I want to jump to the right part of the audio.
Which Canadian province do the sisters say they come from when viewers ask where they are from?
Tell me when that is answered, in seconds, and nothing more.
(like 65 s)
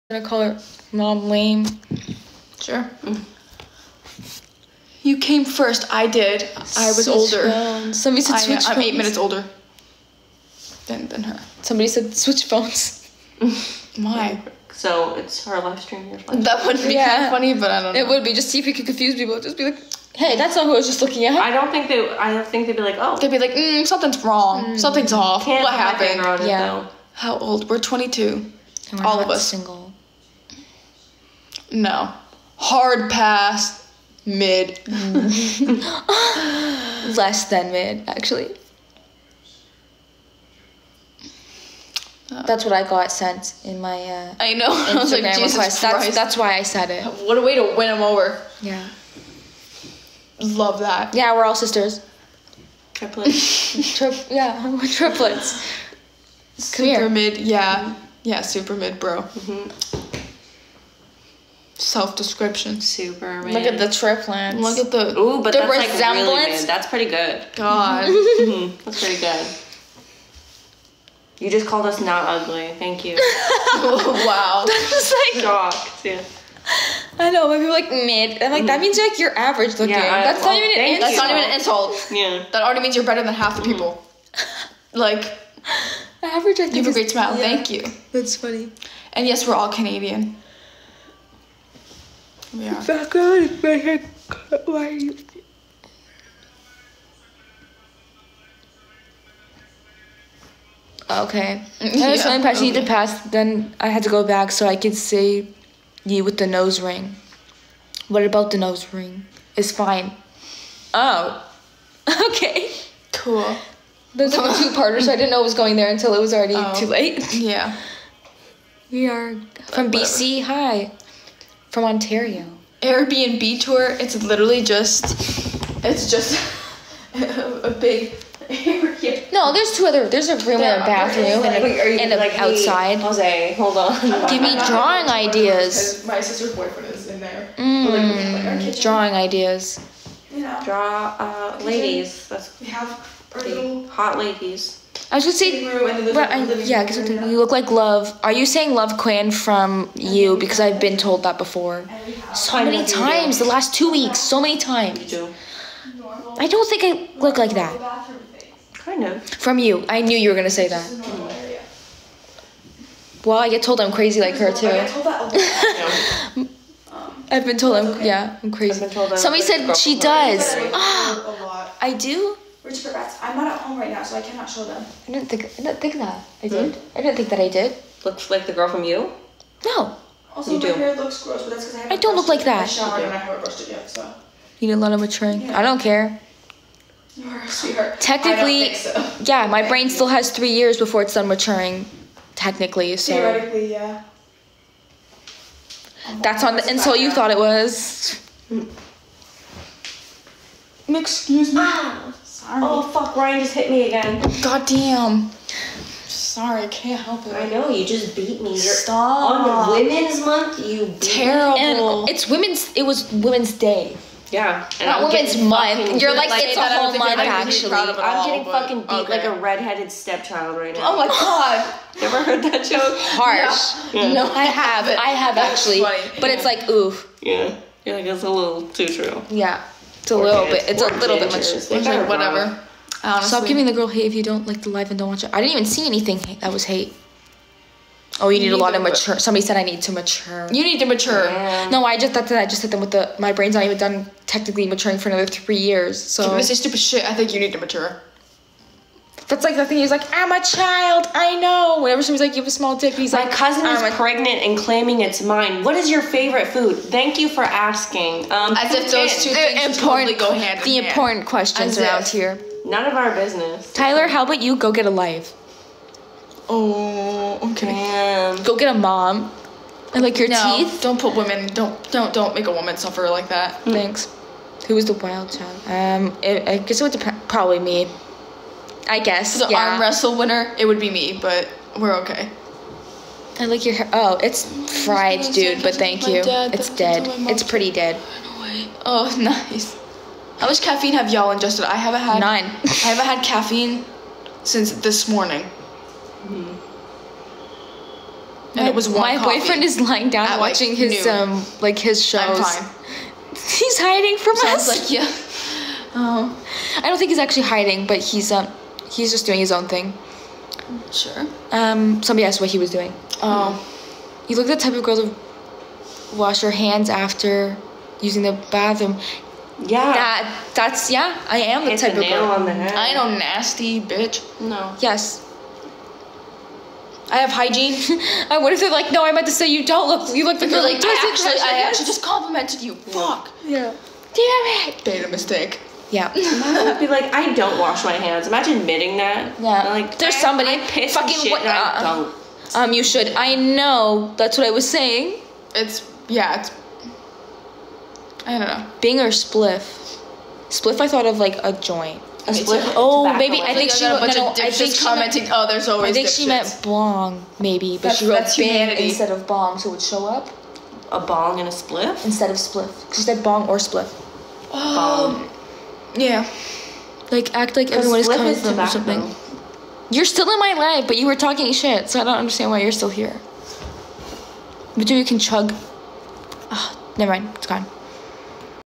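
119 s.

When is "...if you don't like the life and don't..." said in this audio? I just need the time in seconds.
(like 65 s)
234 s.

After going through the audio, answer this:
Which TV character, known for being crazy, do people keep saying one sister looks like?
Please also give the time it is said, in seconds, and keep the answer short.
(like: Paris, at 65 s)
Love Quinn, at 148 s.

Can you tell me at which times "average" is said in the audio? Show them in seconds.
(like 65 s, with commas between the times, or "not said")
79 s, 86 s.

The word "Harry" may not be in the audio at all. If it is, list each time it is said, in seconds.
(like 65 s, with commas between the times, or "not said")
not said.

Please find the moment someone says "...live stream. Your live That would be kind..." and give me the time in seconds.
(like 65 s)
15 s.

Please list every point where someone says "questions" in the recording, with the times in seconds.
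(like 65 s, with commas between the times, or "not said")
261 s.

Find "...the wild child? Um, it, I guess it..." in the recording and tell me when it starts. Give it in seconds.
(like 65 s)
274 s.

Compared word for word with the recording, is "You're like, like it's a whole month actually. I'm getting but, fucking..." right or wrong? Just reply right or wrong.
right.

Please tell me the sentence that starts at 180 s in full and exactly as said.
hair looks gross, but that's because I haven't.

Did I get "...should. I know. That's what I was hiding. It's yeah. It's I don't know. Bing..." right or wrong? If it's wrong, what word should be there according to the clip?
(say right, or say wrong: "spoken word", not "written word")
wrong: "saying", not "hiding".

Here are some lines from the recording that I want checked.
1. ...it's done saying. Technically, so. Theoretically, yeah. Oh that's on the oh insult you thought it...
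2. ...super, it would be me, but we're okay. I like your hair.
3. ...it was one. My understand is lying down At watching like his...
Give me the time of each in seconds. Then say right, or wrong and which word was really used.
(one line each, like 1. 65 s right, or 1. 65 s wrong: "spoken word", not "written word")
1. 191 s wrong: "maturing", not "saying"
2. 280 s wrong: "winner", not "super"
3. 298 s wrong: "boyfriend", not "understand".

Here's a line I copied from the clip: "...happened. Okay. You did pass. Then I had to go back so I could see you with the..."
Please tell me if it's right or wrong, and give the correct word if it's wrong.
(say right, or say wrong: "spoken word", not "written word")
wrong: "impressed", not "happened".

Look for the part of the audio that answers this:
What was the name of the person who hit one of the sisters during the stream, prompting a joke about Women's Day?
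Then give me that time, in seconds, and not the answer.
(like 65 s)
203 s.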